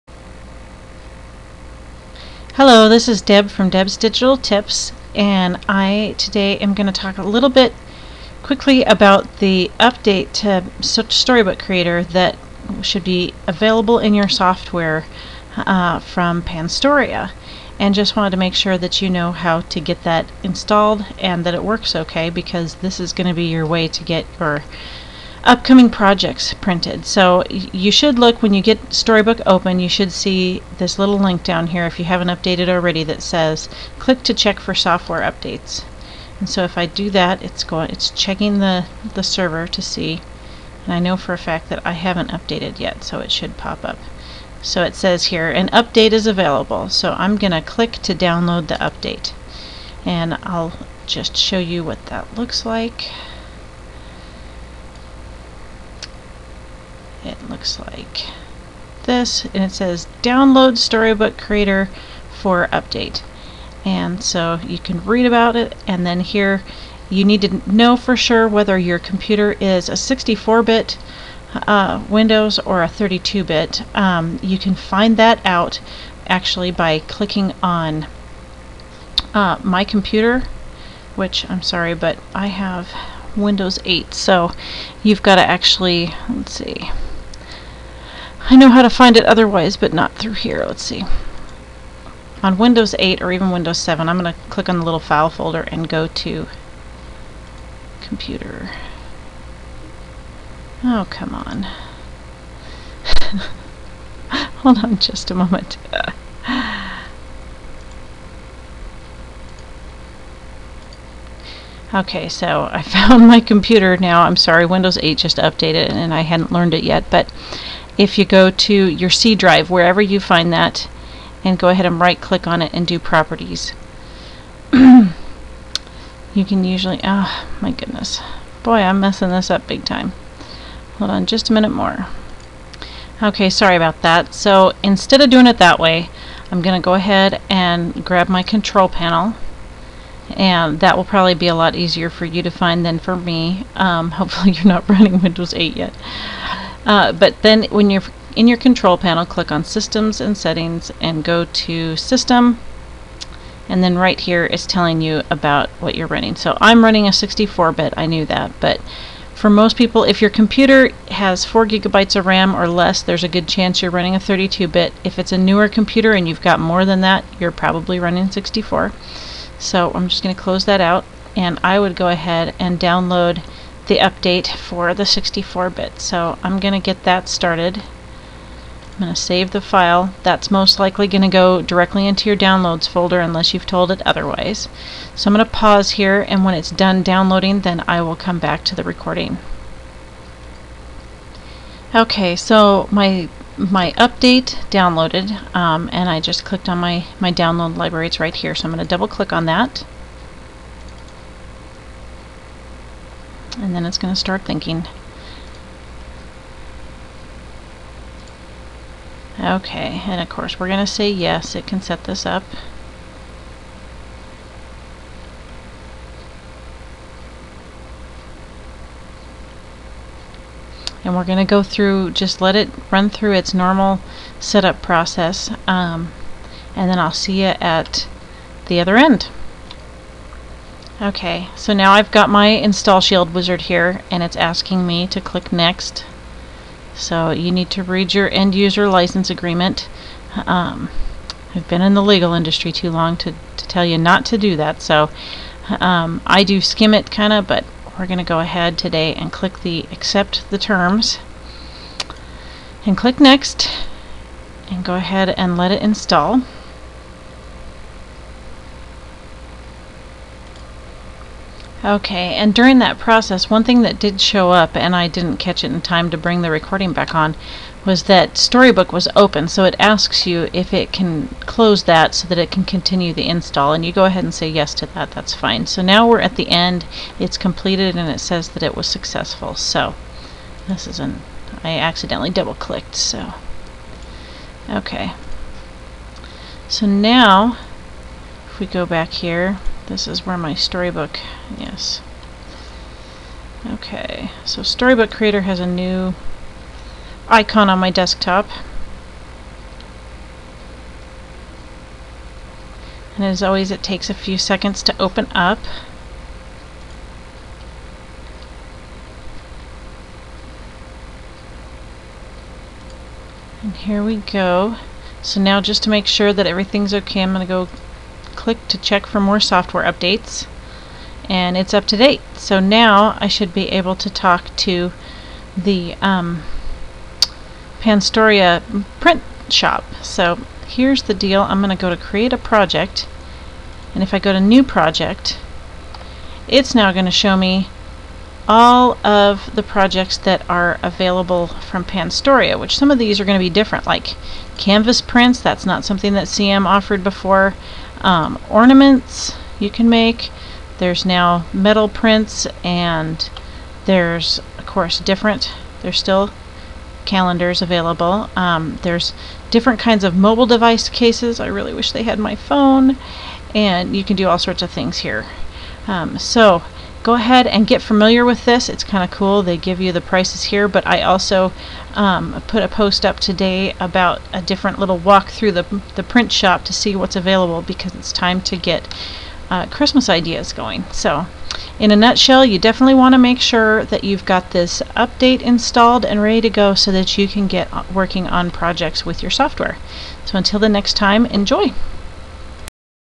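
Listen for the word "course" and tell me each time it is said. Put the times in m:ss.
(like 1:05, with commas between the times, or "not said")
3:30, 5:54.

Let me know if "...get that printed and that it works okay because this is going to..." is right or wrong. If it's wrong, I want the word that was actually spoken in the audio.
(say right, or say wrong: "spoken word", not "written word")
wrong: "installed", not "printed".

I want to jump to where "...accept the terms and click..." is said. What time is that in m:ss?
4:09.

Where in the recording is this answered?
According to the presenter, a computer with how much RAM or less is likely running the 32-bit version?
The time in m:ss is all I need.
2:41.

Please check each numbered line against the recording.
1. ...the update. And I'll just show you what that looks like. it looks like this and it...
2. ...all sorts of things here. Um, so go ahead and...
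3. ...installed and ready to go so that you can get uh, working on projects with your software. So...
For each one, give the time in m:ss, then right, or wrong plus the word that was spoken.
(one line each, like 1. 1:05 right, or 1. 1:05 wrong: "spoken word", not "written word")
1. 0:48 right
2. 6:04 right
3. 6:25 right.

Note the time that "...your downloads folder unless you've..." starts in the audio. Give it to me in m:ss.
3:02.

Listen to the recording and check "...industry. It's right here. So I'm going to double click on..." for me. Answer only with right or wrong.
wrong.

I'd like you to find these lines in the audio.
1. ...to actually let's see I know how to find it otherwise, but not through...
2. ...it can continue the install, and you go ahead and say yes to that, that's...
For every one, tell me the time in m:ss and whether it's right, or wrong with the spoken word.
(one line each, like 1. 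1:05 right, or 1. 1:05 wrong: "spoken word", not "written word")
1. 1:25 right
2. 4:32 right.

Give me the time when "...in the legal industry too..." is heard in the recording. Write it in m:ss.
4:01.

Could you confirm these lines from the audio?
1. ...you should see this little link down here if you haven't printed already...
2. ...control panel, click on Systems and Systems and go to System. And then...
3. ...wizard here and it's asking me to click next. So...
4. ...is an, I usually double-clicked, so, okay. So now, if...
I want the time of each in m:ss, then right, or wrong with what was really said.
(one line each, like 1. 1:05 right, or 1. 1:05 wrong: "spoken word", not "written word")
1. 0:29 wrong: "updated", not "printed"
2. 2:28 wrong: "Settings", not "Systems"
3. 3:53 right
4. 4:40 wrong: "accidentally", not "usually".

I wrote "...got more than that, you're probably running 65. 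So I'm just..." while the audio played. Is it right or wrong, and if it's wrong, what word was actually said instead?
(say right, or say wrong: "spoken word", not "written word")
wrong: "64", not "65".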